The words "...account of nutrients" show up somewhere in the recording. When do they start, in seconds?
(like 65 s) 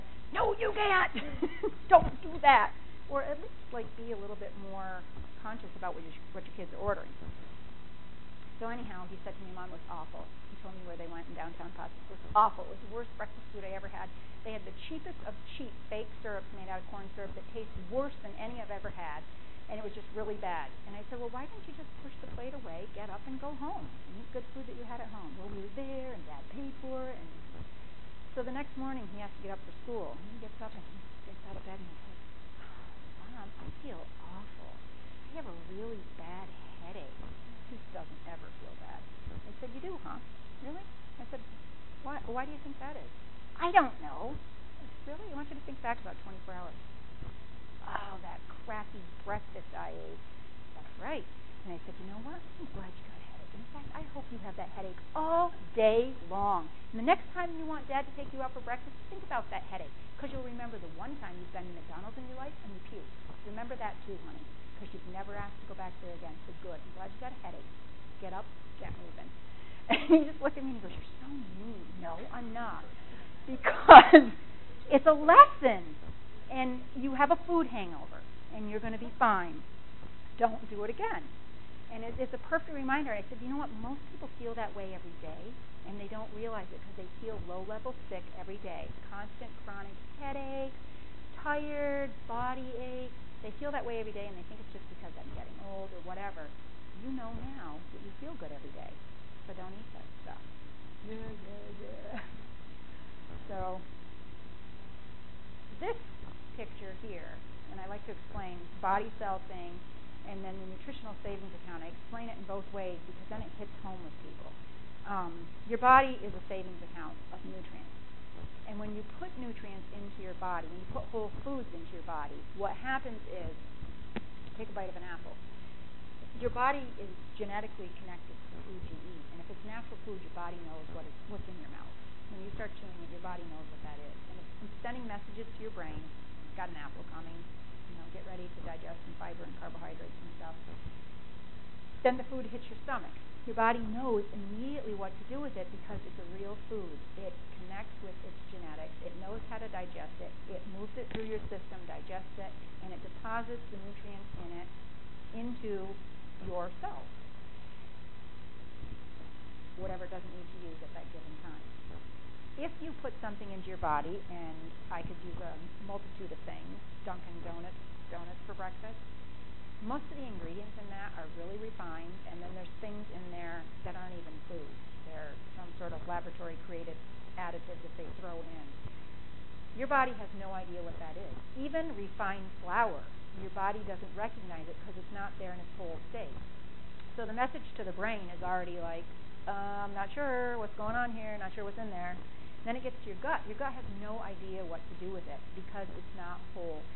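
116 s.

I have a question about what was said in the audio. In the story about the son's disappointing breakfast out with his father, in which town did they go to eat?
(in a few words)
Potts.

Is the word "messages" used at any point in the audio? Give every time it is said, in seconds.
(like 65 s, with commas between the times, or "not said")
135 s, 187 s.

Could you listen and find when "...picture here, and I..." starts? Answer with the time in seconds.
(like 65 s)
106 s.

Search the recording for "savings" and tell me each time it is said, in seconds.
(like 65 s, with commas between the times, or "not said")
111 s, 116 s.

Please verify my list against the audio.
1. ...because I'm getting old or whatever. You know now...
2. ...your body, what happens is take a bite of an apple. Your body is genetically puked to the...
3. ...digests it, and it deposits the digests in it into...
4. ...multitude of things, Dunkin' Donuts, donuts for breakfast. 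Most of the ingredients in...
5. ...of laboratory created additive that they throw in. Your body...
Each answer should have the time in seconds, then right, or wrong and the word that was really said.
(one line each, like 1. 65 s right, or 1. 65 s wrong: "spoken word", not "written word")
1. 94 s right
2. 121 s wrong: "connected", not "puked"
3. 151 s wrong: "nutrients", not "digests"
4. 165 s right
5. 175 s right.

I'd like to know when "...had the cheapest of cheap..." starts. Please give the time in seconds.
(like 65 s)
14 s.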